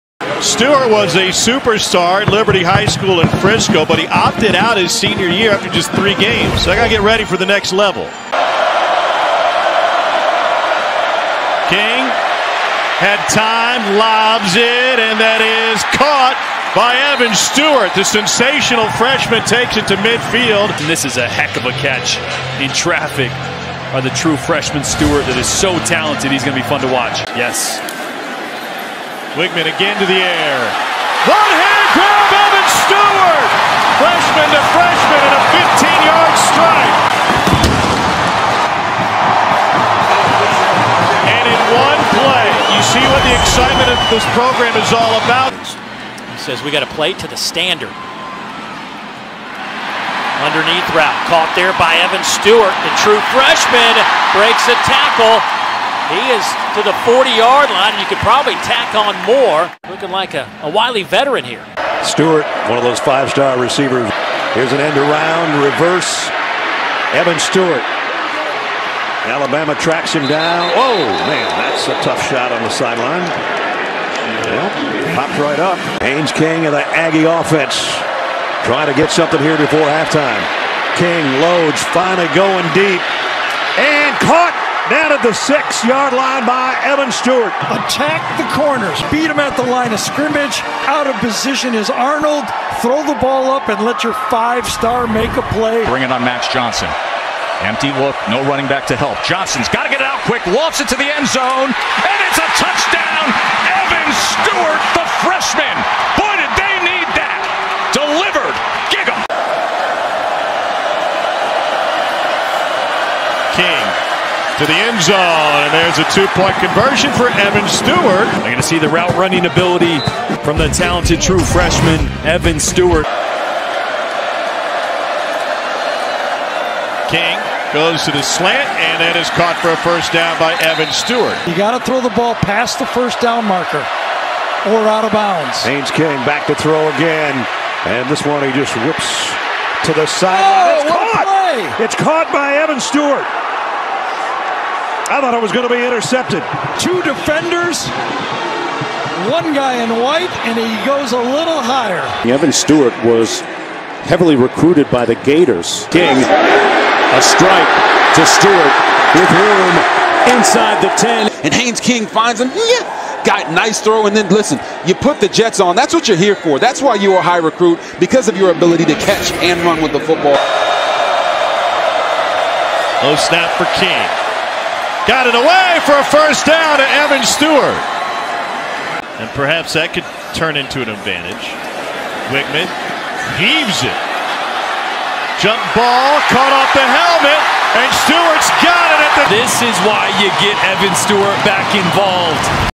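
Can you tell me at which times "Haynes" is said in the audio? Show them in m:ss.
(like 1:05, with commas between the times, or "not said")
1:16, 2:15, 2:41.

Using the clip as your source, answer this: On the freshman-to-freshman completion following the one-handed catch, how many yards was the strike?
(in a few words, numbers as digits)
15.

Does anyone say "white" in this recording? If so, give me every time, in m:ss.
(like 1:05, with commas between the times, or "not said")
2:29.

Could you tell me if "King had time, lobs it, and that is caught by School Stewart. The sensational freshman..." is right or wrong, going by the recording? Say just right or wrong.
wrong.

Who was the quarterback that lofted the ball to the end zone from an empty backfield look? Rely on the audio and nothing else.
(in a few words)
Max Johnson.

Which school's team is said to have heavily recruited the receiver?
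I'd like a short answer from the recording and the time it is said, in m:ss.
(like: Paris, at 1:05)
the Gators, at 2:35.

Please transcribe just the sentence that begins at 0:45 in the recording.
He says, we got to play to the standard.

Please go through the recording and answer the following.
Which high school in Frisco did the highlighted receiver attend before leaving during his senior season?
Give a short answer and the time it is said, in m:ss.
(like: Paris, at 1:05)
Liberty High School, at 0:02.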